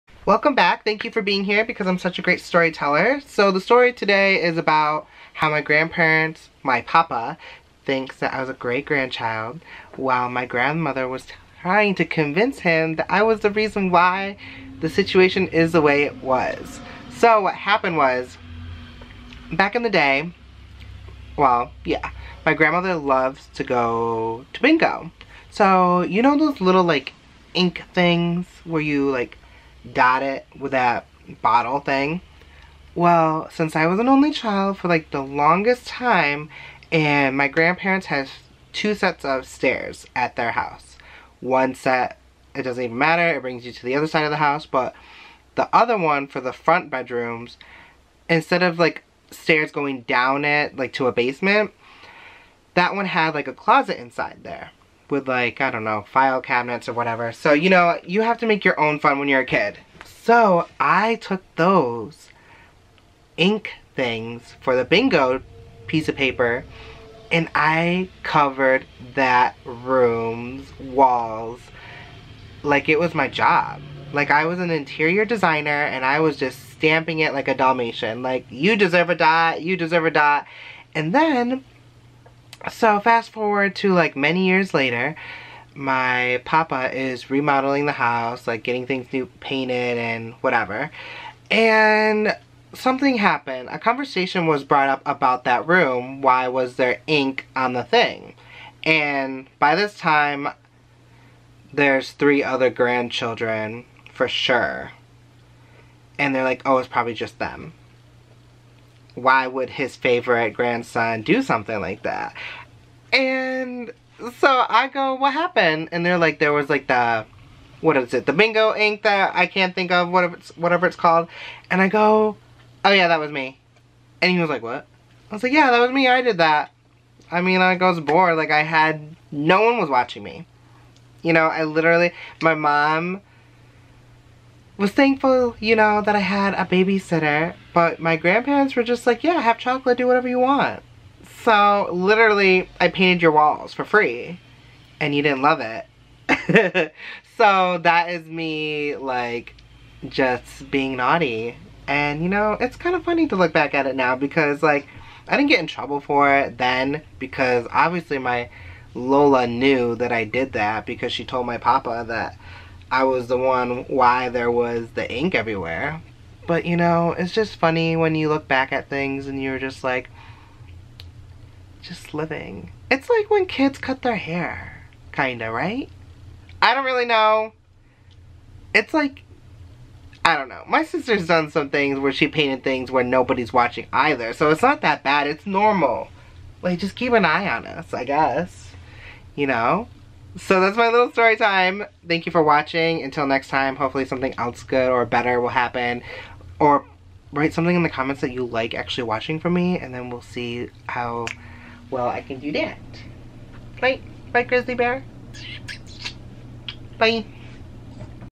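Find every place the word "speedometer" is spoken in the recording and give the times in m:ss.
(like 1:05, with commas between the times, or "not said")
not said.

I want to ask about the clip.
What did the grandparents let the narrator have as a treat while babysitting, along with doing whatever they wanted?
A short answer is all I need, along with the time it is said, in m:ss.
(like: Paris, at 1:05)
Chocolate, at 2:19.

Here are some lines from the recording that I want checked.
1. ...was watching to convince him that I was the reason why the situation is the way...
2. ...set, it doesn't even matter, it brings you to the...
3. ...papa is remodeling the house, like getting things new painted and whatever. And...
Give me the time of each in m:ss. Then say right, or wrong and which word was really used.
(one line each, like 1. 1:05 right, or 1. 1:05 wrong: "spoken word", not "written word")
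1. 0:11 wrong: "trying", not "watching"
2. 0:41 right
3. 1:26 right.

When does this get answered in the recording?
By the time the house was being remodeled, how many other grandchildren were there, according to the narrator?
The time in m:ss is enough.
1:42.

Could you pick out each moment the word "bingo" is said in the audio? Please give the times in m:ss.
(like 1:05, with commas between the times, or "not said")
0:24, 1:04, 1:58.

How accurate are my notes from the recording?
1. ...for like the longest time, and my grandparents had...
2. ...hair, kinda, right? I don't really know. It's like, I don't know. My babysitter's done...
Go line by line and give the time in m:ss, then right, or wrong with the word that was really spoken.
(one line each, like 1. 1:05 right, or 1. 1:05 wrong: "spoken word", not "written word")
1. 0:34 right
2. 2:54 wrong: "sister", not "babysitter".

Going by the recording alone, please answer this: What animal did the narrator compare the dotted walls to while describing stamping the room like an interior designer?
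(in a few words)
Dalmatian.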